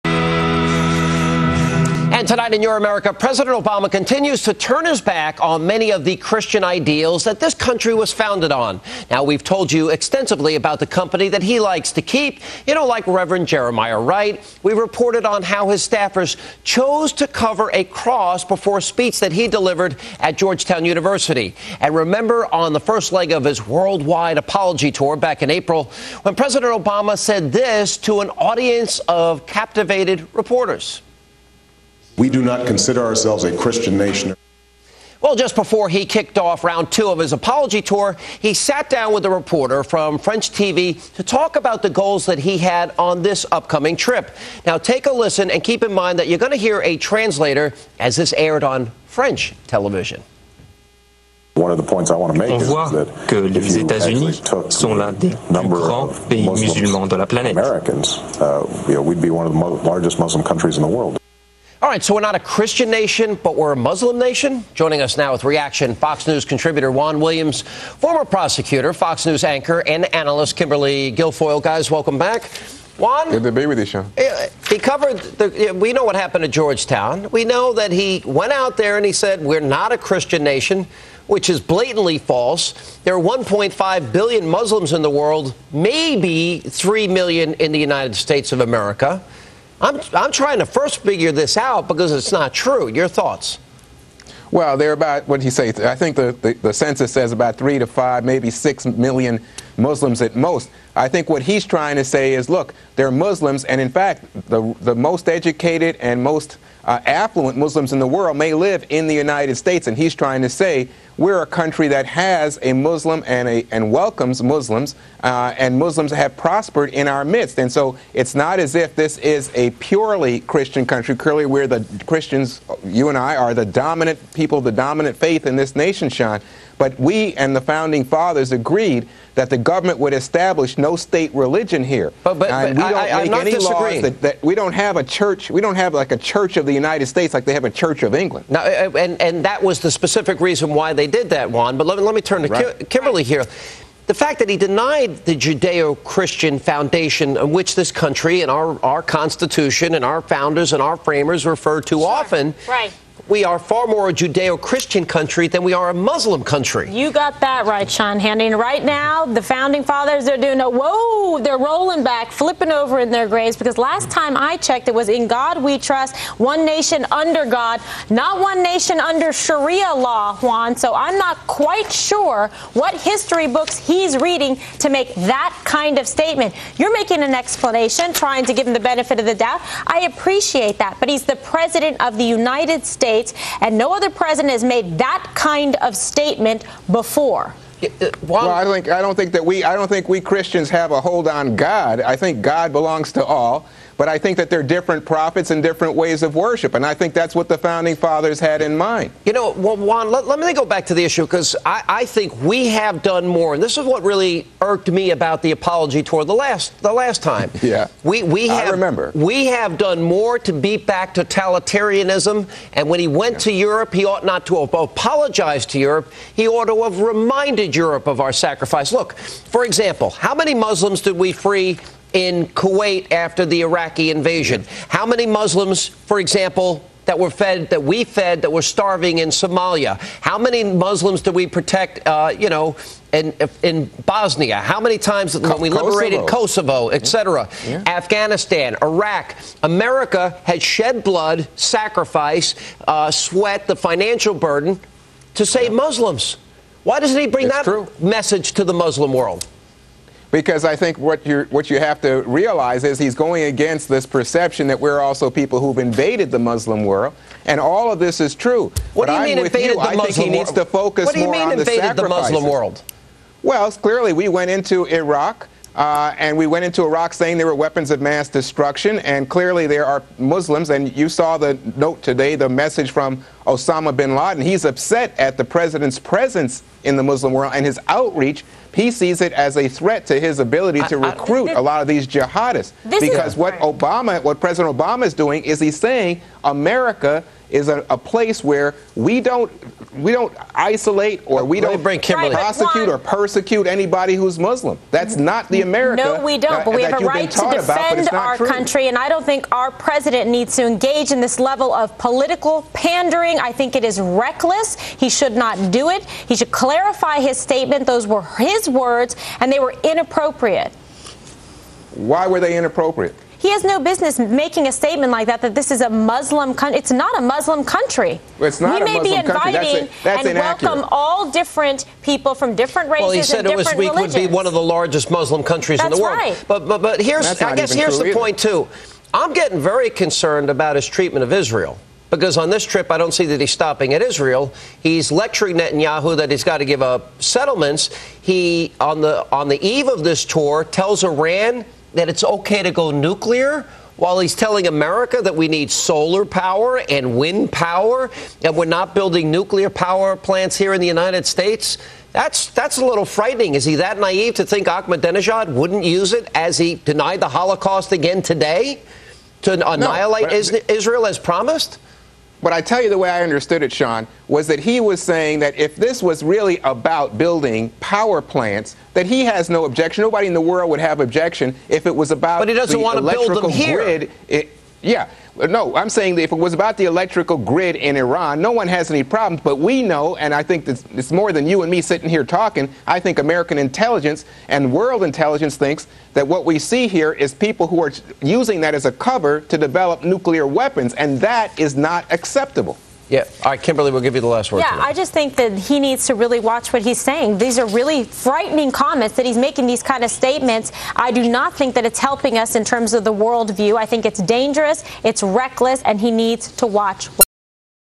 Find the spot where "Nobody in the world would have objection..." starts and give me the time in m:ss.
6:10.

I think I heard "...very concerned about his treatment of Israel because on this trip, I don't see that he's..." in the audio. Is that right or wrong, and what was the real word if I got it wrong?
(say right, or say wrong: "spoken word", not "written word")
right.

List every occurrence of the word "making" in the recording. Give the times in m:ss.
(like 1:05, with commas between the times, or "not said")
2:56, 5:14, 6:39.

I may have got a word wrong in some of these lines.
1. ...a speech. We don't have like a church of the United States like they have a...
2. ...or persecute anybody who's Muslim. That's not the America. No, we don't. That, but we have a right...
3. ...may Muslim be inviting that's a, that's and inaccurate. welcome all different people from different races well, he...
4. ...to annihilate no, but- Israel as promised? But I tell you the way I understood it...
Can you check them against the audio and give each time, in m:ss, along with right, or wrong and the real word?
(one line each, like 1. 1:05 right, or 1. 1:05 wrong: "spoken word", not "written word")
1. 2:14 wrong: "church", not "speech"
2. 4:52 right
3. 5:18 right
4. 5:59 right.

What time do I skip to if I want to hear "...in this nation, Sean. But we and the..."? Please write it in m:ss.
2:05.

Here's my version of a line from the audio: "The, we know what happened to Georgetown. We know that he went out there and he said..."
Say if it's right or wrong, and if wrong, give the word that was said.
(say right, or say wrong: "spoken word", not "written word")
right.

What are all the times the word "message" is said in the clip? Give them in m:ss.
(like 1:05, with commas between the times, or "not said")
4:07, 4:32.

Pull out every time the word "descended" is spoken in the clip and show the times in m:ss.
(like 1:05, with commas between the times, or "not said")
not said.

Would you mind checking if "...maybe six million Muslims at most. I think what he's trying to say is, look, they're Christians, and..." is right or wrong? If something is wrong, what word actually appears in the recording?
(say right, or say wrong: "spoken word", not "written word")
wrong: "Muslims", not "Christians".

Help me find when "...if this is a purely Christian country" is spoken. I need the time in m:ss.
1:58.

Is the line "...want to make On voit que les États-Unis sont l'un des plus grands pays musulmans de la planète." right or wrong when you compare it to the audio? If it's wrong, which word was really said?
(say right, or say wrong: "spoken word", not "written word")
right.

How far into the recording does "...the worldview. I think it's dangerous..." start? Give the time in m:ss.
6:43.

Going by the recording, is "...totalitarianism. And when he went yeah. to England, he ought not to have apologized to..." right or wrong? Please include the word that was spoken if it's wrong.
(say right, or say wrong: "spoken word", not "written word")
wrong: "Europe", not "England".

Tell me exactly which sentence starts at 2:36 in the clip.
You got that right, Sean Hannity.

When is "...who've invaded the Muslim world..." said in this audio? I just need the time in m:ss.
4:15.